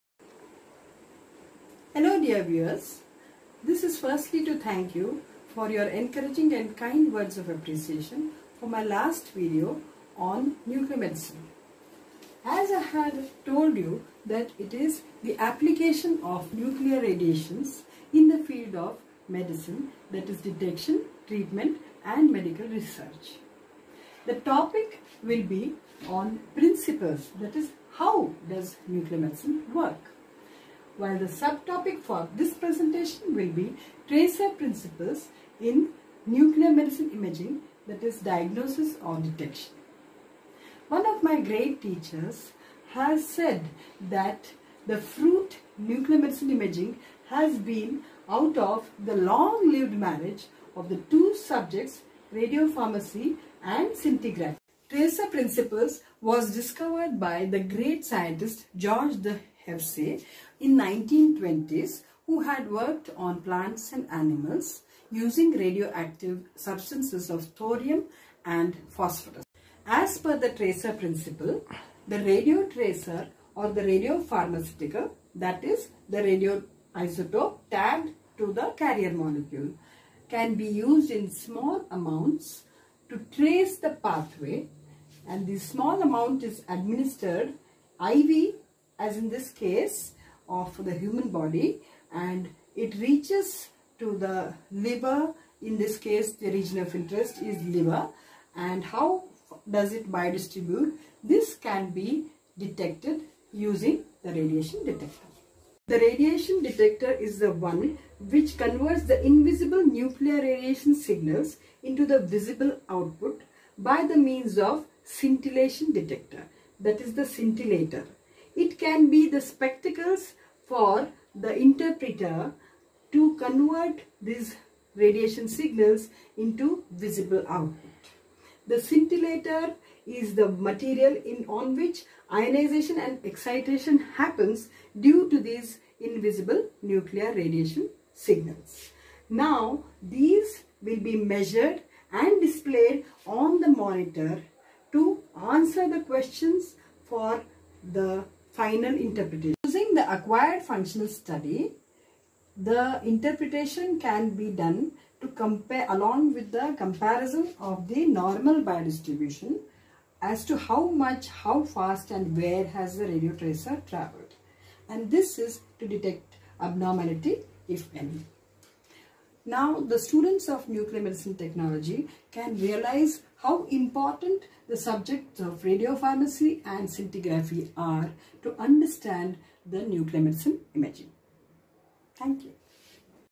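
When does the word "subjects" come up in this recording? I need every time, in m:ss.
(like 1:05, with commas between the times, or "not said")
0:51, 2:54.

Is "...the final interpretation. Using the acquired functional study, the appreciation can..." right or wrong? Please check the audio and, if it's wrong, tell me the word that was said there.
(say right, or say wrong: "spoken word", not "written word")
wrong: "interpretation", not "appreciation".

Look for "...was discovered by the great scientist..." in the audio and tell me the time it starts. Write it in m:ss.
0:56.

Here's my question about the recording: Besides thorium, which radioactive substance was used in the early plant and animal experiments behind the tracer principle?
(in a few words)
phosphorus.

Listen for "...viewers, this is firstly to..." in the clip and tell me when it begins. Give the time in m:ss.
0:02.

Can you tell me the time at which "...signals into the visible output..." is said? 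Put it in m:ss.
1:51.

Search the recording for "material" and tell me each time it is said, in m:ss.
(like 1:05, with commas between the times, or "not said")
2:10.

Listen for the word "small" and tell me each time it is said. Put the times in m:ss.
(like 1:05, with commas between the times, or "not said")
1:21, 1:25.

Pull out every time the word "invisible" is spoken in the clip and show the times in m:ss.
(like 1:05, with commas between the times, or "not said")
1:49, 2:15.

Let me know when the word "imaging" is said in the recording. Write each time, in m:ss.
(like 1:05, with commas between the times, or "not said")
0:37, 0:46, 3:00.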